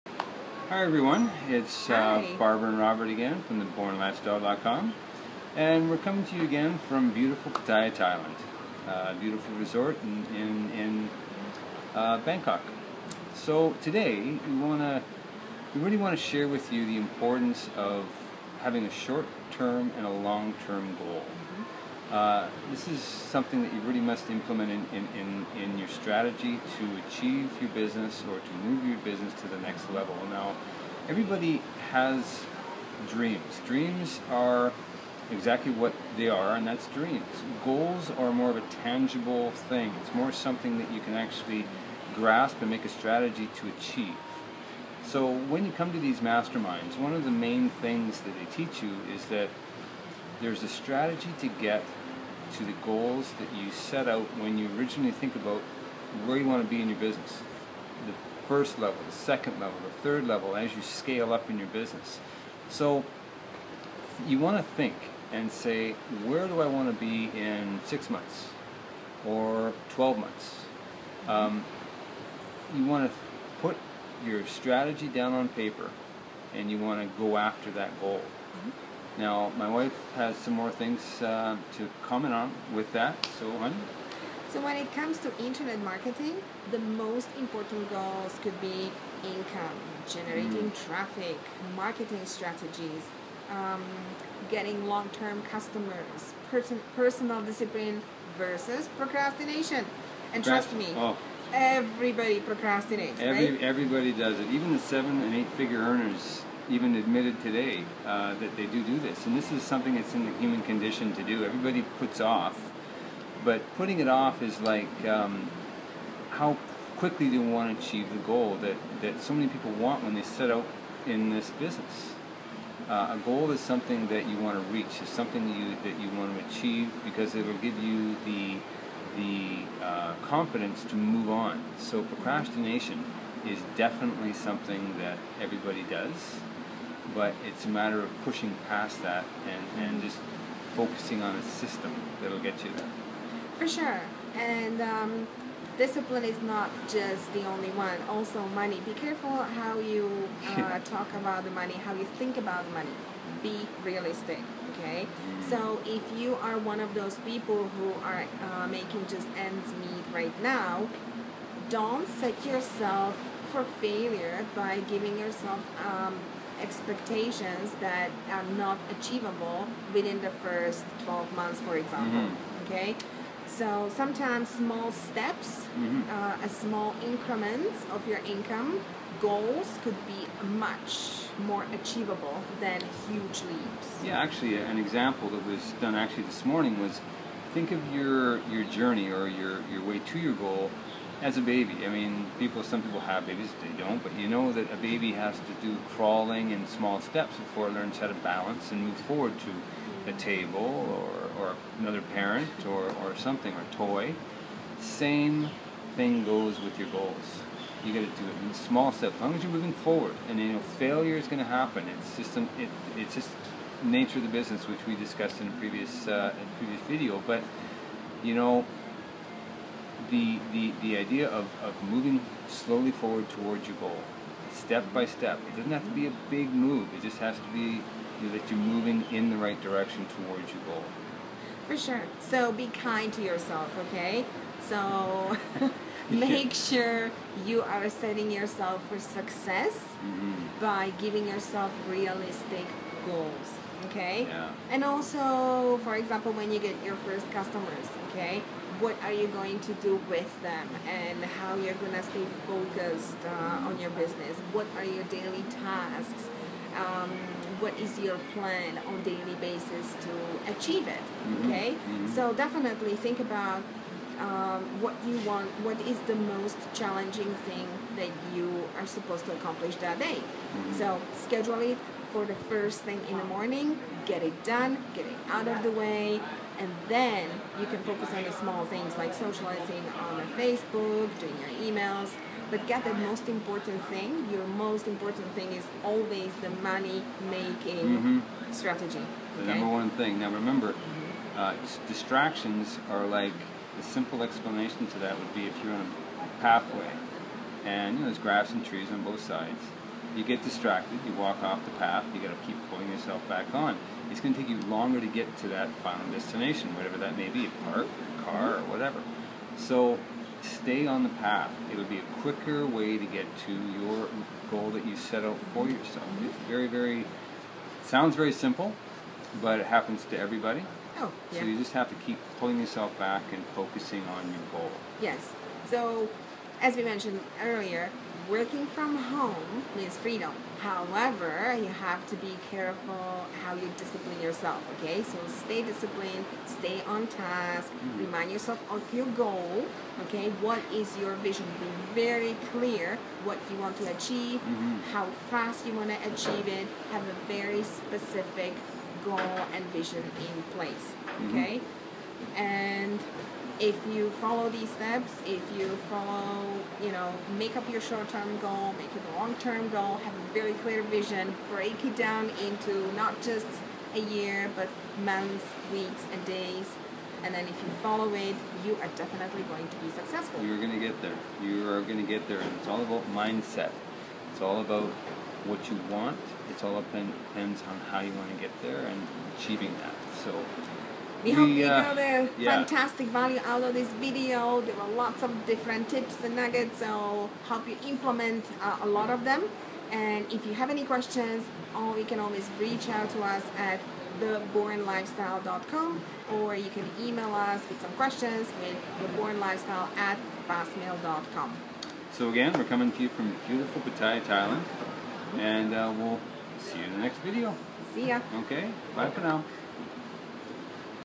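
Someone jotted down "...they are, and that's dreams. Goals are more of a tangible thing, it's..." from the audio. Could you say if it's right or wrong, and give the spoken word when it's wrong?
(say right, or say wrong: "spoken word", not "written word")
right.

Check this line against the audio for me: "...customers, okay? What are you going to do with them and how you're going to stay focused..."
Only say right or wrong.
right.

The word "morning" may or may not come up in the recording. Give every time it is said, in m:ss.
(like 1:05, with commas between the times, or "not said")
3:06, 4:33.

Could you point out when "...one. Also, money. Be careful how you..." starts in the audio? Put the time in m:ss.
2:27.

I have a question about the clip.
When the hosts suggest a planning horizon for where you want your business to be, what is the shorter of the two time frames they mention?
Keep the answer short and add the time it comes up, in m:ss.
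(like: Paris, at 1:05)
6 months, at 1:07.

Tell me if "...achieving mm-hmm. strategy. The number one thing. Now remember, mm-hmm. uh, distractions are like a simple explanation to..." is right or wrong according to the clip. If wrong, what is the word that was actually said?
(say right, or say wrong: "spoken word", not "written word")
wrong: "making", not "achieving".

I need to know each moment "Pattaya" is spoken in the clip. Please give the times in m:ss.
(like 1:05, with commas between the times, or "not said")
0:07, 6:43.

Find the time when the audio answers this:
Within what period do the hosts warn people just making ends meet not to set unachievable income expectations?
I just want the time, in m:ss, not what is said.
2:50.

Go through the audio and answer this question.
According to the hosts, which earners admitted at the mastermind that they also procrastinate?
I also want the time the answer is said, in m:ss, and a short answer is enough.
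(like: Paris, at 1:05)
Seven and eight-figure earners, at 1:44.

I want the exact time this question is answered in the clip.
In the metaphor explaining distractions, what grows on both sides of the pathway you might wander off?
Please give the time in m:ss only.
4:58.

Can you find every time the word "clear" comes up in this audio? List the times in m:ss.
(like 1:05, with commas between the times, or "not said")
5:42, 6:00.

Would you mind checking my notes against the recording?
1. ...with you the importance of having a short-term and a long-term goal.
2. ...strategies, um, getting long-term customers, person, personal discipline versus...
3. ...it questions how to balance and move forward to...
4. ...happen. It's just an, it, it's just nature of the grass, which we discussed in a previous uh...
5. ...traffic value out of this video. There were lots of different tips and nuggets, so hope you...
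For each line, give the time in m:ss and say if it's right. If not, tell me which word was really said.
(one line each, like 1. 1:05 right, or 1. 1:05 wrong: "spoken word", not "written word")
1. 0:16 right
2. 1:32 right
3. 3:17 wrong: "learns", not "questions"
4. 3:31 wrong: "business", not "grass"
5. 6:22 wrong: "fantastic", not "traffic".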